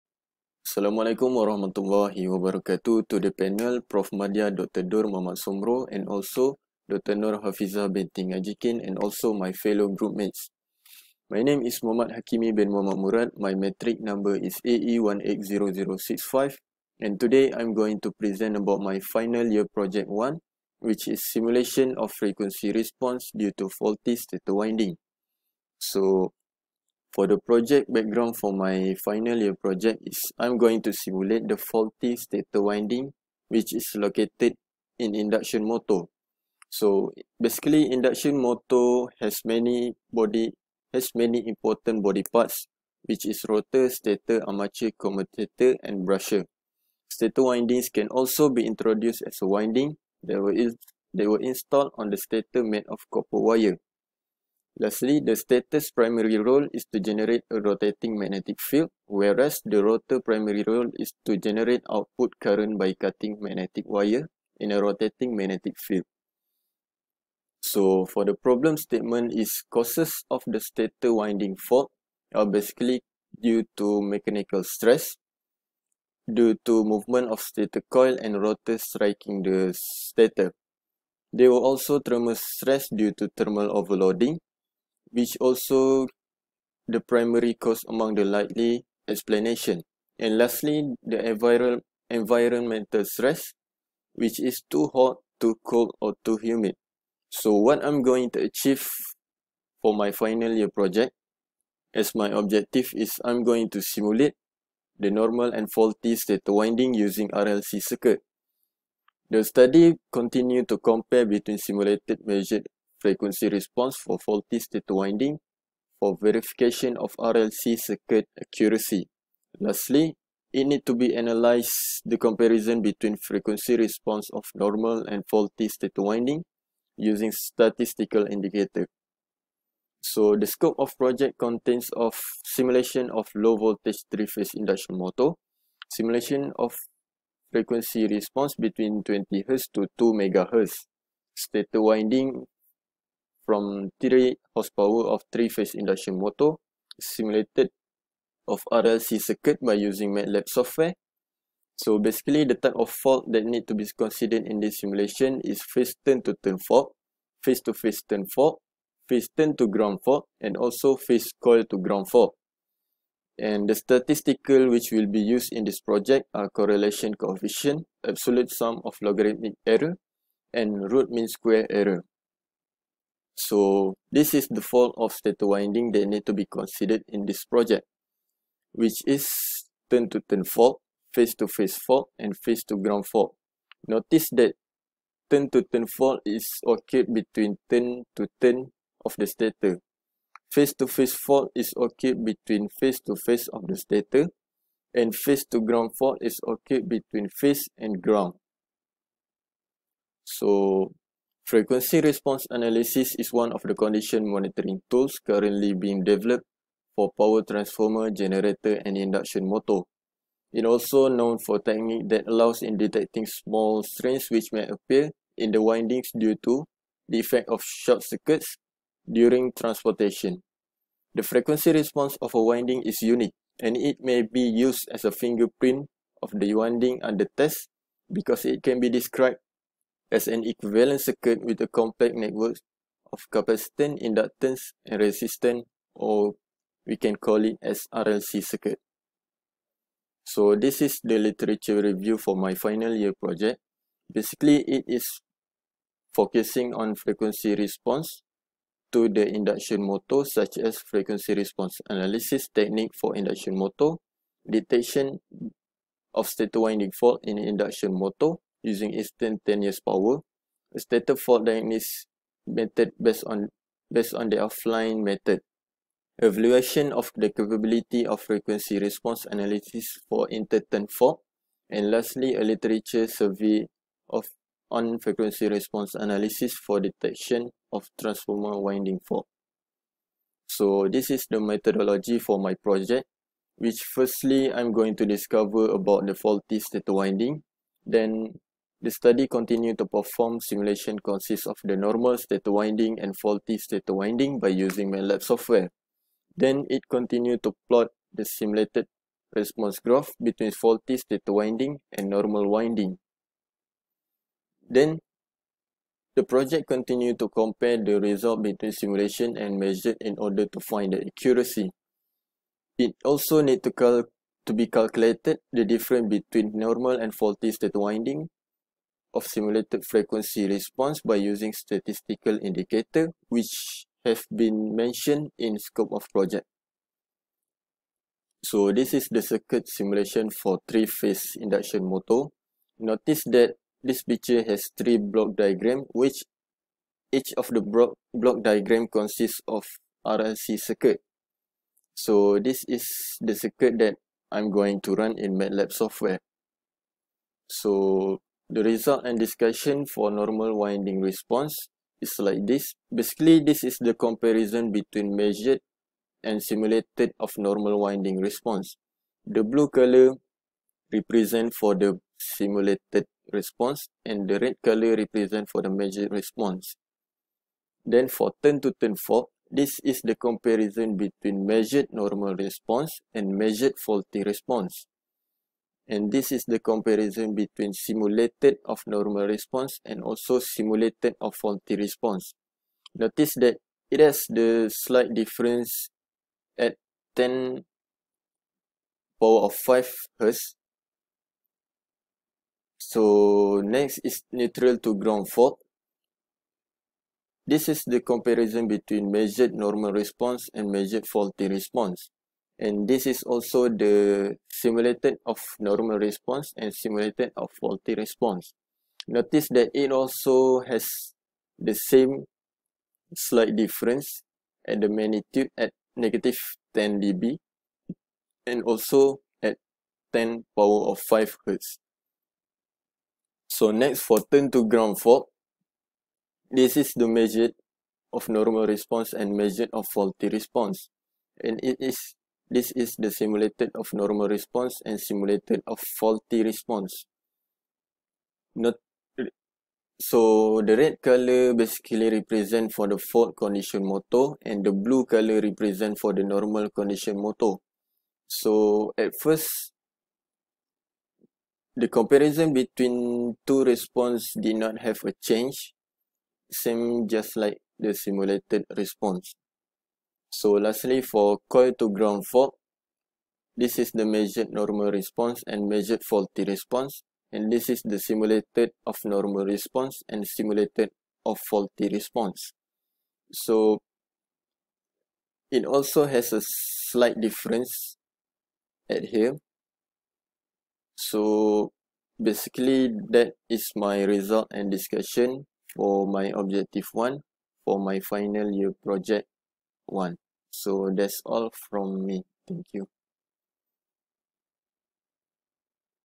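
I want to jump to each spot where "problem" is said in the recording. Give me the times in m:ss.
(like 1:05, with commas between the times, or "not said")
1:08.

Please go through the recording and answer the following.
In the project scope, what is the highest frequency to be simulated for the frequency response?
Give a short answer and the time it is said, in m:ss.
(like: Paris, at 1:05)
2 MHz, at 2:19.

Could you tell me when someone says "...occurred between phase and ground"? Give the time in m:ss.
3:16.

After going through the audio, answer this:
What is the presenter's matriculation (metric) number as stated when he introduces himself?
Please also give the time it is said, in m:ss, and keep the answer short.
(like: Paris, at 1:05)
AE180065, at 0:14.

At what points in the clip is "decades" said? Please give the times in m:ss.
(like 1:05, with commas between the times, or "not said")
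not said.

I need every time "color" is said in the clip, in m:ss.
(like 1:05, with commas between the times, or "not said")
5:59, 6:04, 7:21, 7:25.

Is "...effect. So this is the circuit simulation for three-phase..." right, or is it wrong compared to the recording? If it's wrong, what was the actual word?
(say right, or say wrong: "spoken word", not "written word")
wrong: "project", not "effect".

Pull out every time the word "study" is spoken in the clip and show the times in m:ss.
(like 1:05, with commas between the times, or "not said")
1:49, 4:48.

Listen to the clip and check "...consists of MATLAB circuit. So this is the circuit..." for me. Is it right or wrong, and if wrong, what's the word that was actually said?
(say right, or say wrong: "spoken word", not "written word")
wrong: "RLC", not "MATLAB".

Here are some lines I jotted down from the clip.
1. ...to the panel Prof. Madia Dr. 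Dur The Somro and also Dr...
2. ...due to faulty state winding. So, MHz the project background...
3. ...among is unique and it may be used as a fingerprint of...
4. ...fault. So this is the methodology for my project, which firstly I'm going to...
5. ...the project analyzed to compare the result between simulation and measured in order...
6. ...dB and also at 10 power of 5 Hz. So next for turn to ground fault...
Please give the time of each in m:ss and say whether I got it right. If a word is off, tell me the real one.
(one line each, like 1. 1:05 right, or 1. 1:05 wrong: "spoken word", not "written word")
1. 0:03 wrong: "Muhammad", not "The"
2. 0:23 wrong: "For", not "MHz"
3. 3:42 wrong: "winding", not "among"
4. 4:39 right
5. 5:06 wrong: "continued", not "analyzed"
6. 6:57 right.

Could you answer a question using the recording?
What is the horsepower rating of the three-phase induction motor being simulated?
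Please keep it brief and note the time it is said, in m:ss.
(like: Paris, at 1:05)
3 horsepower, at 2:23.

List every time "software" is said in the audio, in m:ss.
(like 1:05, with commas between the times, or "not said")
2:30, 4:55, 5:45.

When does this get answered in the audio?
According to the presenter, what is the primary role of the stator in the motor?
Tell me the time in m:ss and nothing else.
0:56.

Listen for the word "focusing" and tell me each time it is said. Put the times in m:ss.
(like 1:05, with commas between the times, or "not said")
4:06.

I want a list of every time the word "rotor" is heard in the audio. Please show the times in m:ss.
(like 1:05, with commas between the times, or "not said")
0:43, 0:59, 1:18.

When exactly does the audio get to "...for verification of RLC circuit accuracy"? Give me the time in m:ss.
1:55.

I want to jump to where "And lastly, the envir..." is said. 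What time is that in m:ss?
1:30.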